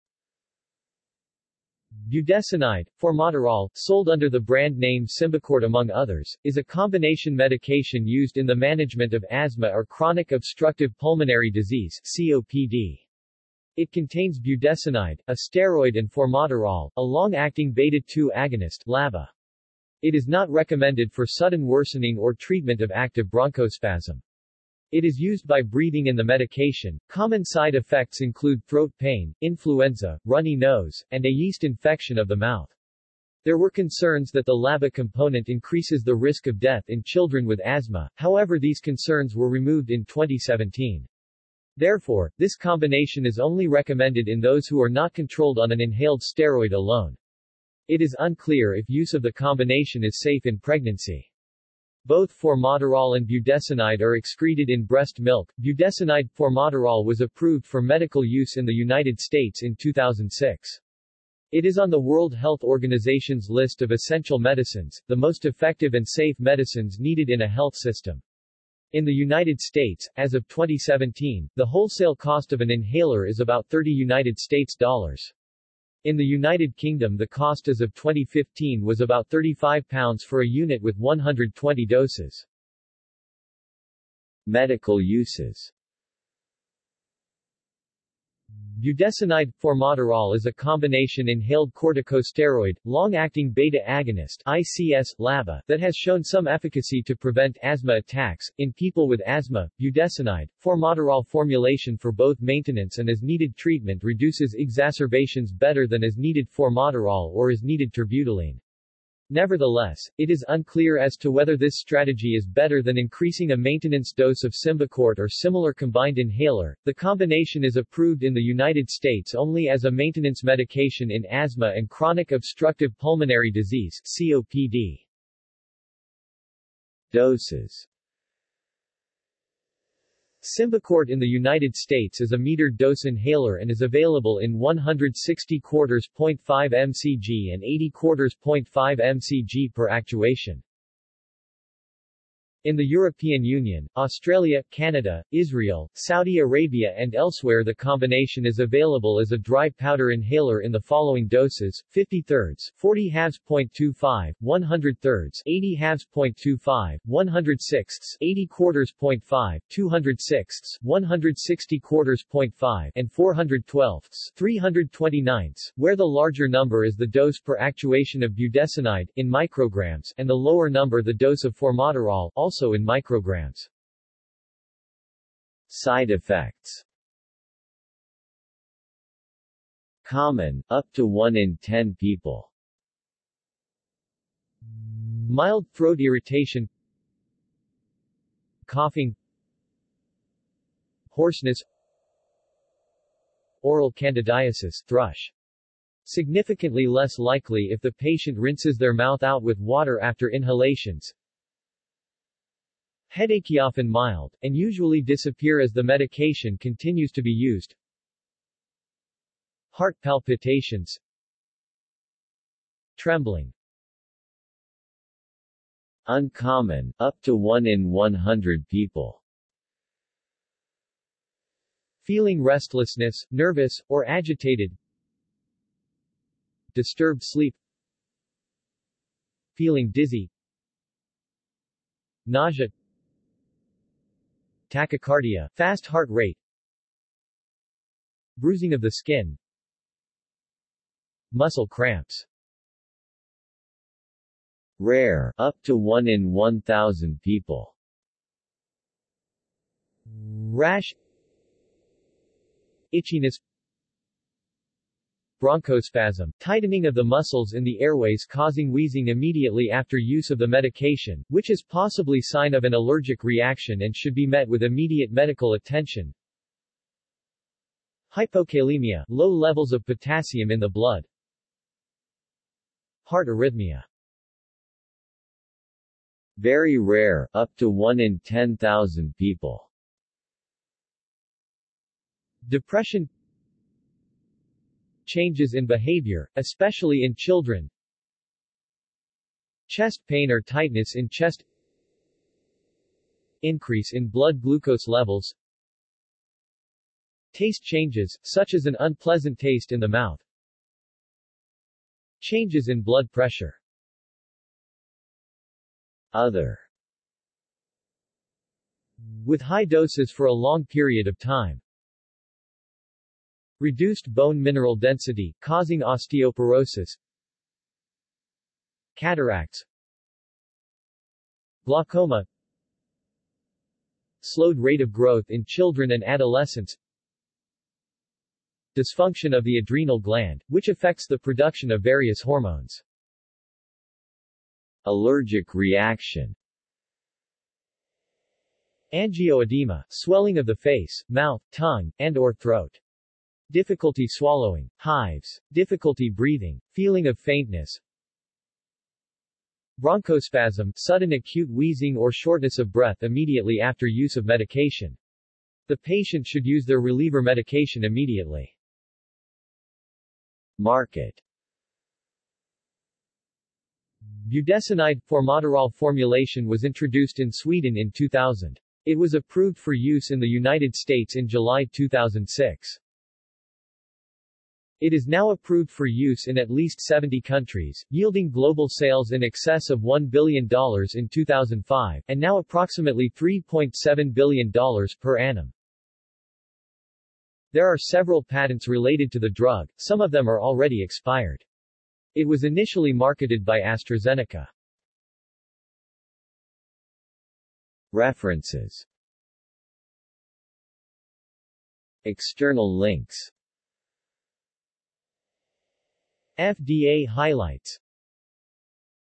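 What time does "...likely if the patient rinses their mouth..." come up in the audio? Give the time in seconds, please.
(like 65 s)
197 s.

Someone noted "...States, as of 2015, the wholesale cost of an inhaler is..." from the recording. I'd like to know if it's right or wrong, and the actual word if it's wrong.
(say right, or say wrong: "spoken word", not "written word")
wrong: "2017", not "2015".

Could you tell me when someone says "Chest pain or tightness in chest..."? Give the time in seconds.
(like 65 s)
289 s.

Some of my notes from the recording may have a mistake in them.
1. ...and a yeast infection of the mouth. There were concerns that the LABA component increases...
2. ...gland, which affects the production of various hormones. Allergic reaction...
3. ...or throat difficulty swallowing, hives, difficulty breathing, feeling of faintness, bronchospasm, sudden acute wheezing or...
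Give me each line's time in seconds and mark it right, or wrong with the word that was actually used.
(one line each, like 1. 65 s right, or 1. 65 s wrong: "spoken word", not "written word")
1. 31 s right
2. 329 s right
3. 342 s right.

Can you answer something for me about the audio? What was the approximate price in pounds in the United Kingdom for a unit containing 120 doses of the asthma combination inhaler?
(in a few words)
£35.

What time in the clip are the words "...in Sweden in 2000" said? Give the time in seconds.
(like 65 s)
367 s.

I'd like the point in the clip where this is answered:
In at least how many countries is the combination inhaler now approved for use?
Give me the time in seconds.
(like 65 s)
376 s.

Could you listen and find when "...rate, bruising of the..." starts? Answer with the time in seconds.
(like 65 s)
236 s.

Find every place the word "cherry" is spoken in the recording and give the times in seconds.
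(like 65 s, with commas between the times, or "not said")
not said.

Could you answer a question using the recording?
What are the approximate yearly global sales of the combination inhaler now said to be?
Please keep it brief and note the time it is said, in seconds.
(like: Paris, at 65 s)
$3.7 billion, at 383 s.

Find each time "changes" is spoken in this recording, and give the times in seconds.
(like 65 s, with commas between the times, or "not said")
285 s, 297 s, 302 s.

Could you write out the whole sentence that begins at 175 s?
Side effects Common, up to 1 in 10 people.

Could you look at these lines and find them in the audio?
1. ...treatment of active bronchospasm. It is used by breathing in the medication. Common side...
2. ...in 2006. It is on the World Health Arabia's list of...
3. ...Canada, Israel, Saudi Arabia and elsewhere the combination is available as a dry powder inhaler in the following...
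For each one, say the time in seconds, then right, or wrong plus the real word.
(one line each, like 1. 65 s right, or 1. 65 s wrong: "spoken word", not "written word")
1. 22 s right
2. 59 s wrong: "Organization", not "Arabia"
3. 144 s right.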